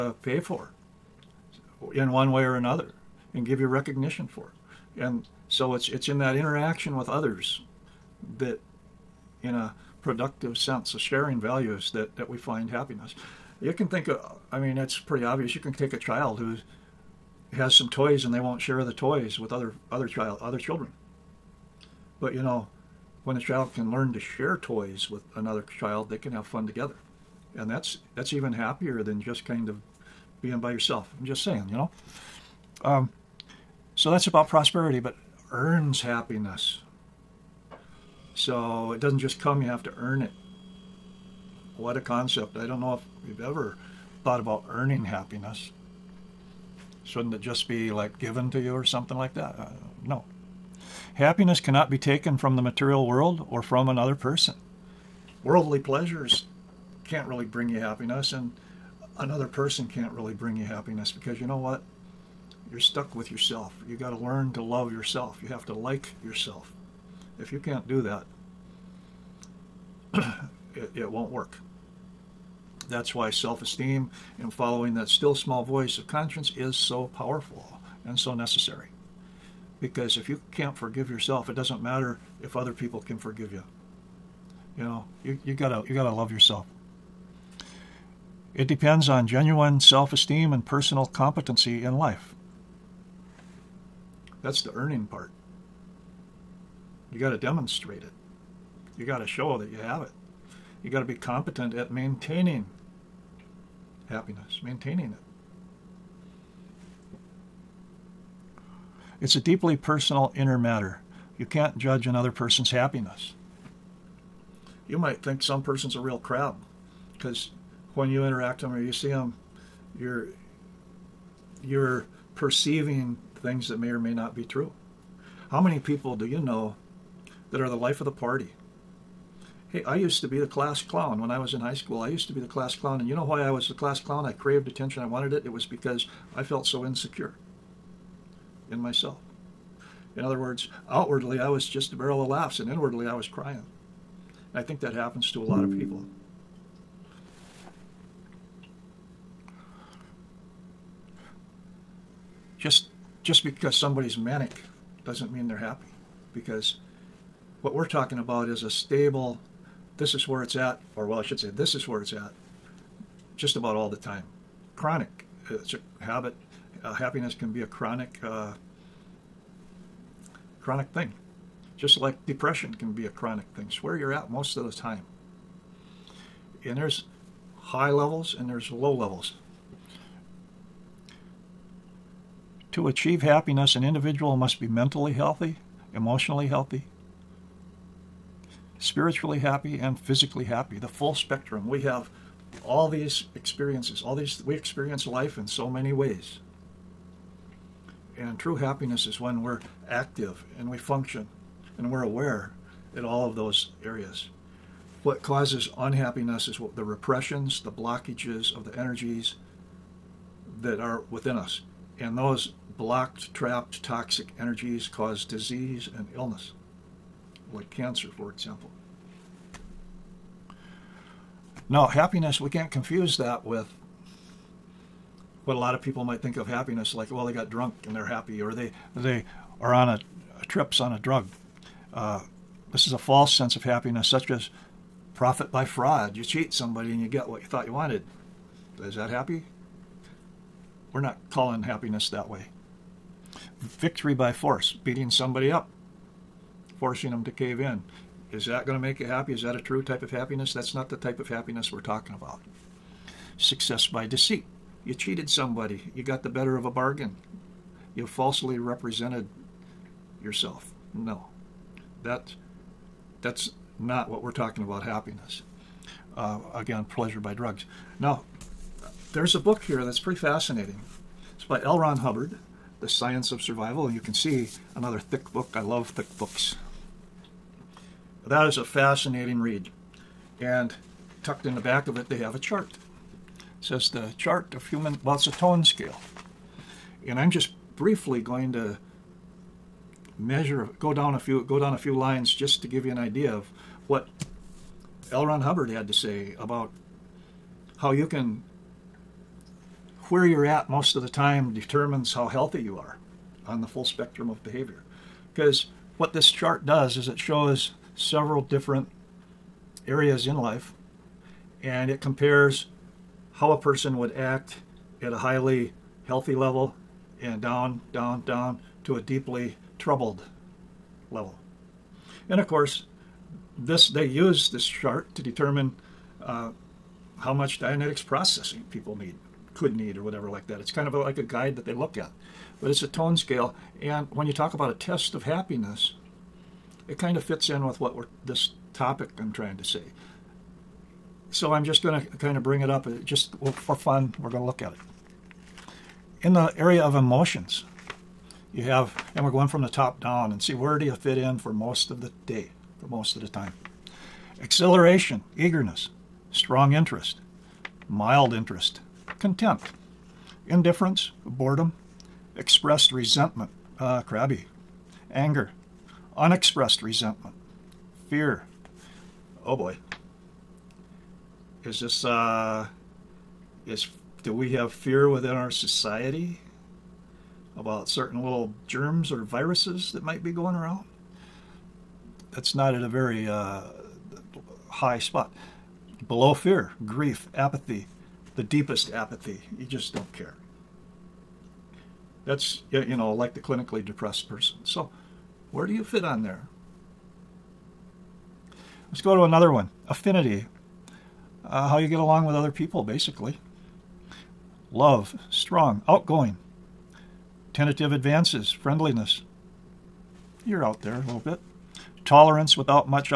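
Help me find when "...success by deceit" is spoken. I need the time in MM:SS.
04:13.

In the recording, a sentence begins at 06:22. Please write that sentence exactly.
That's not at a very uh, high spot.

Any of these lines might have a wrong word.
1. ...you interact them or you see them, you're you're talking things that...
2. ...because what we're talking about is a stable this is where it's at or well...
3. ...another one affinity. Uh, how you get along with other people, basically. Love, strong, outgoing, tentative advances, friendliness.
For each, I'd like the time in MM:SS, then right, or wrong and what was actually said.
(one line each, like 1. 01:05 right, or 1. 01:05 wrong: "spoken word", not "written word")
1. 01:58 wrong: "perceiving", not "talking"
2. 02:36 right
3. 06:39 right.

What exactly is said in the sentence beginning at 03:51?
Uh, this is a false sense of happiness, such as profit by fraud.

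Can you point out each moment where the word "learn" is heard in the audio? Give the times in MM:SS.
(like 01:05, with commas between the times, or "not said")
00:23, 01:04.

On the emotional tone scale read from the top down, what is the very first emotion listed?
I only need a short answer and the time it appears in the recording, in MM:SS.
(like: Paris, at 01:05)
Exhilaration, at 05:54.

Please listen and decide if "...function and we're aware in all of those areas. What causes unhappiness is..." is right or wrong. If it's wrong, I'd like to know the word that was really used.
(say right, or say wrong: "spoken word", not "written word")
right.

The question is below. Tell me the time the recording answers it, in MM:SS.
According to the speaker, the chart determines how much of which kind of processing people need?
05:27.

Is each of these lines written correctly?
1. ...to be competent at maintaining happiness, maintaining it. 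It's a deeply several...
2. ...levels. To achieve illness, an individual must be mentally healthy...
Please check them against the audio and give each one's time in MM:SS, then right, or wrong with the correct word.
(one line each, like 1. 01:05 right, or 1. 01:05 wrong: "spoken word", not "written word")
1. 01:40 wrong: "personal", not "several"
2. 02:58 wrong: "happiness", not "illness".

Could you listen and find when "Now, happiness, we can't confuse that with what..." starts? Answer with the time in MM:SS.
03:41.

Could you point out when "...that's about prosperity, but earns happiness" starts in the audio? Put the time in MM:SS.
00:34.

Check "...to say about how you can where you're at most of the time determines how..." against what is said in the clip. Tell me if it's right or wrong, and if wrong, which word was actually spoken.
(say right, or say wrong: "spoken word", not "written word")
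right.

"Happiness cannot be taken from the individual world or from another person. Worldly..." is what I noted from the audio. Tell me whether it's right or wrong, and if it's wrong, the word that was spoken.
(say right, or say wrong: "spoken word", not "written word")
wrong: "material", not "individual".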